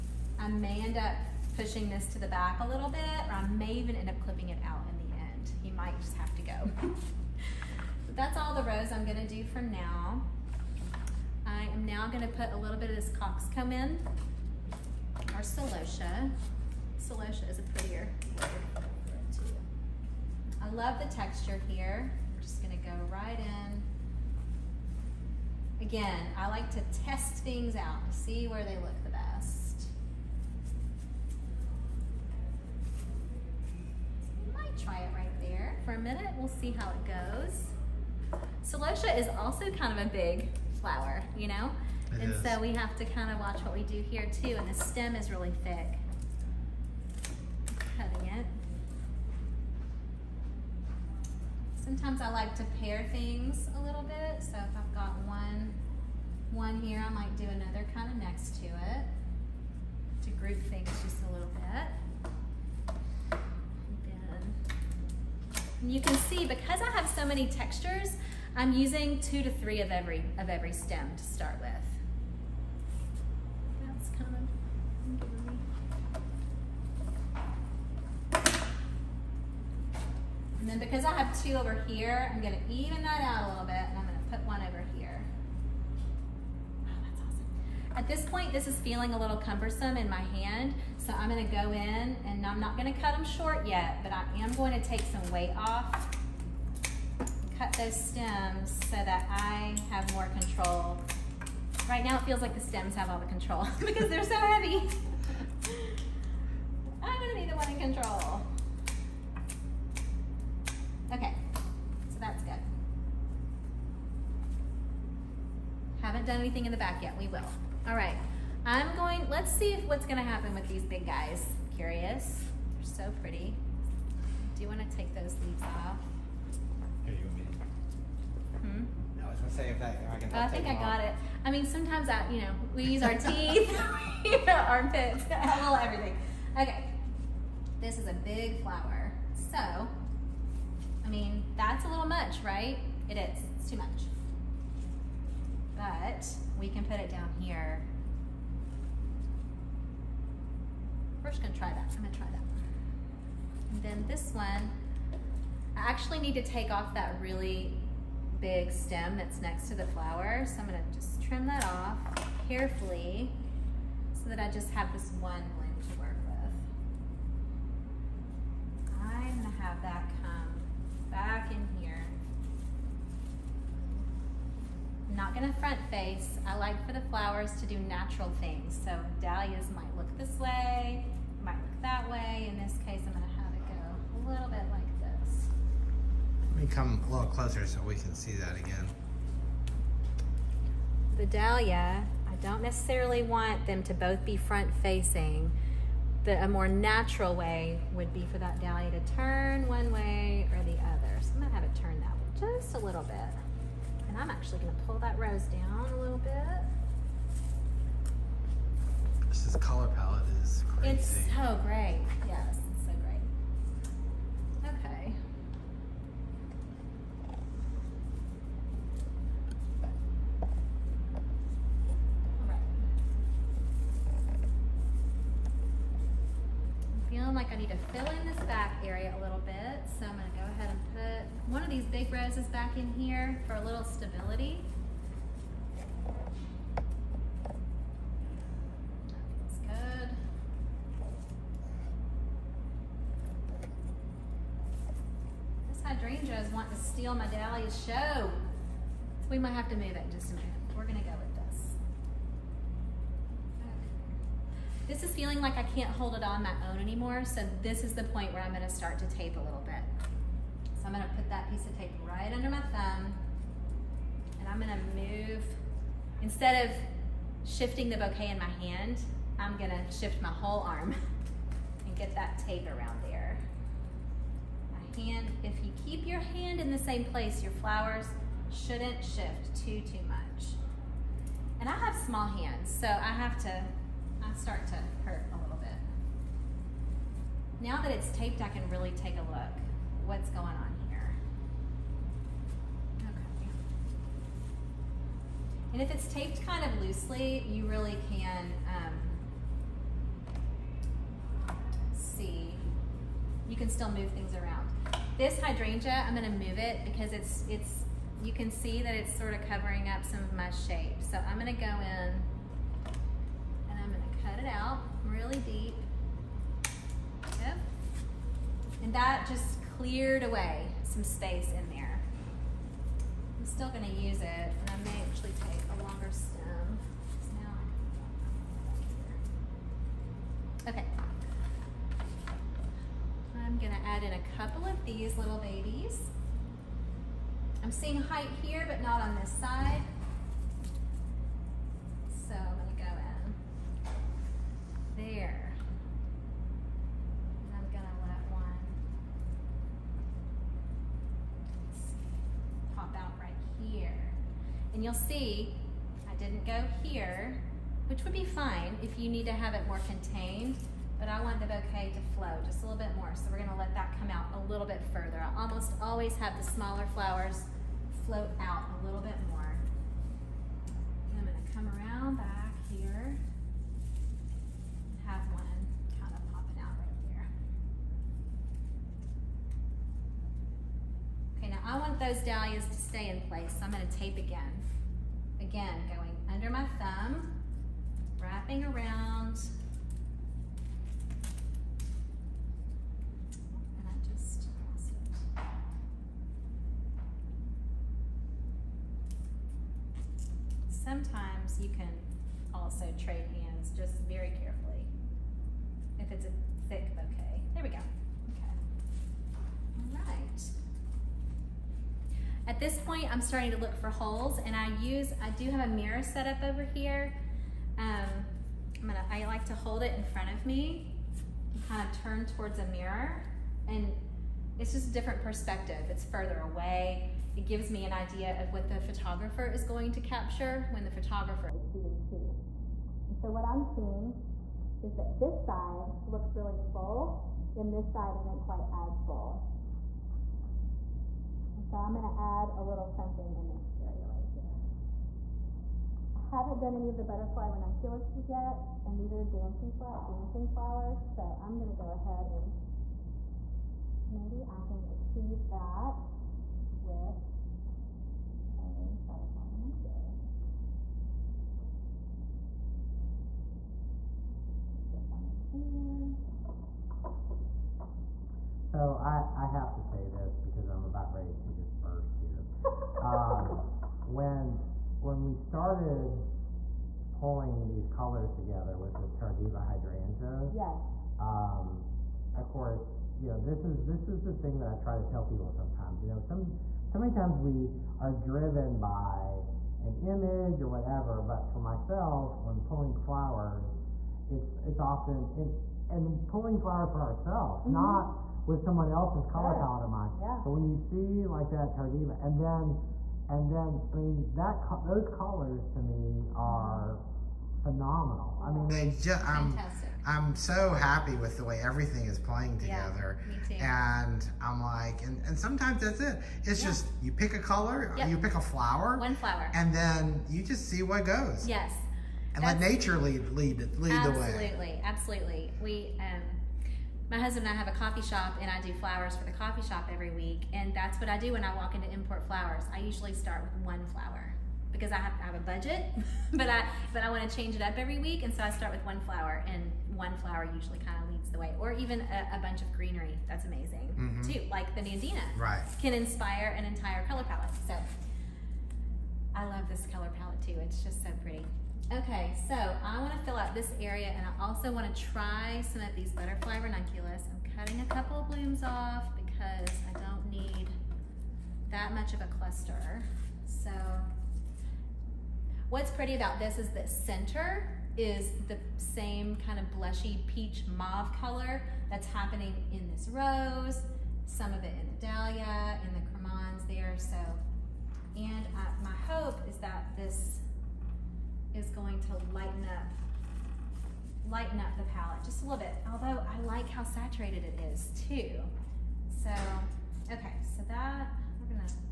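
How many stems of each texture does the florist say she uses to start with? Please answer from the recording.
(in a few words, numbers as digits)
2 to 3.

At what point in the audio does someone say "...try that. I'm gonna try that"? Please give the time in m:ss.
2:31.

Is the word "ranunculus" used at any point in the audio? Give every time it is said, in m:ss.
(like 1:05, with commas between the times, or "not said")
7:27, 7:39, 9:16.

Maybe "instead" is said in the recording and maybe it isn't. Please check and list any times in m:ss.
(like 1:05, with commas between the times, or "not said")
4:26.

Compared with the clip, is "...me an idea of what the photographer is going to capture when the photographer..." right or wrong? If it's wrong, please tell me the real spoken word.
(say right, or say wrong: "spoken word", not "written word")
right.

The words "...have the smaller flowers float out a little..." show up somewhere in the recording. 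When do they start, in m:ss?
6:06.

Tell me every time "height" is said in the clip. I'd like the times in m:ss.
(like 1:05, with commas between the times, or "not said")
5:37.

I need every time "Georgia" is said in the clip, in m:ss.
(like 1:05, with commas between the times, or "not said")
not said.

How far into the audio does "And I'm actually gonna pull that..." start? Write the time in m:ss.
3:24.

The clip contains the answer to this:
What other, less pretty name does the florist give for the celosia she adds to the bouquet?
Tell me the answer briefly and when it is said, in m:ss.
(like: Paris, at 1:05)
Coxcomb, at 0:13.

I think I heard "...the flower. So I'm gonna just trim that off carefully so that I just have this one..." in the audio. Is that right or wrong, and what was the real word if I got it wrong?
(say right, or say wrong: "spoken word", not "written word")
right.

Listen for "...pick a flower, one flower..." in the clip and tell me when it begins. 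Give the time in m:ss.
8:38.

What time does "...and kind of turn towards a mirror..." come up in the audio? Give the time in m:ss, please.
7:01.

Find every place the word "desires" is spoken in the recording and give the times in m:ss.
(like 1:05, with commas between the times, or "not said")
not said.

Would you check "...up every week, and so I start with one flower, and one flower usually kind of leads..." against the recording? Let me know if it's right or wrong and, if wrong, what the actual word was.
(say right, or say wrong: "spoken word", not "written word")
right.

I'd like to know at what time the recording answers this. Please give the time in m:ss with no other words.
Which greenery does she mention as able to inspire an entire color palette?
9:04.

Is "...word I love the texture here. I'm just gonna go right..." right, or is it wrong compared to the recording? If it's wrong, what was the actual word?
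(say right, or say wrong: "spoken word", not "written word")
right.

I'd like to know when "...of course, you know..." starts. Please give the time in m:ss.
8:02.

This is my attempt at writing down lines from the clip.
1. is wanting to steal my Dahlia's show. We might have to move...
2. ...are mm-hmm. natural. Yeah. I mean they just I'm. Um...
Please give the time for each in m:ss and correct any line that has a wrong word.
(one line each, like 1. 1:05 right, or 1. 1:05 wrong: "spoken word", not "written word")
1. 4:06 right
2. 8:26 wrong: "phenomenal", not "natural".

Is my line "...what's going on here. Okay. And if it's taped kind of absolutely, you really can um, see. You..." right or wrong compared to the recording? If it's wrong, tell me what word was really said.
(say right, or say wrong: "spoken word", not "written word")
wrong: "loosely", not "absolutely".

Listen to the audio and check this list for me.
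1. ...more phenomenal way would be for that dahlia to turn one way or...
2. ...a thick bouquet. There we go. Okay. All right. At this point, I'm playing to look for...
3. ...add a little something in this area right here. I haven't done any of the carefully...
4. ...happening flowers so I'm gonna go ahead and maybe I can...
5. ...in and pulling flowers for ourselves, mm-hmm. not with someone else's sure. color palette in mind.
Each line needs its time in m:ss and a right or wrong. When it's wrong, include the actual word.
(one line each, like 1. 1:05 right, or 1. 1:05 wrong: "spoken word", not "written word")
1. 3:16 wrong: "natural", not "phenomenal"
2. 6:46 wrong: "starting", not "playing"
3. 7:22 wrong: "butterfly", not "carefully"
4. 7:30 wrong: "dancing", not "happening"
5. 8:15 right.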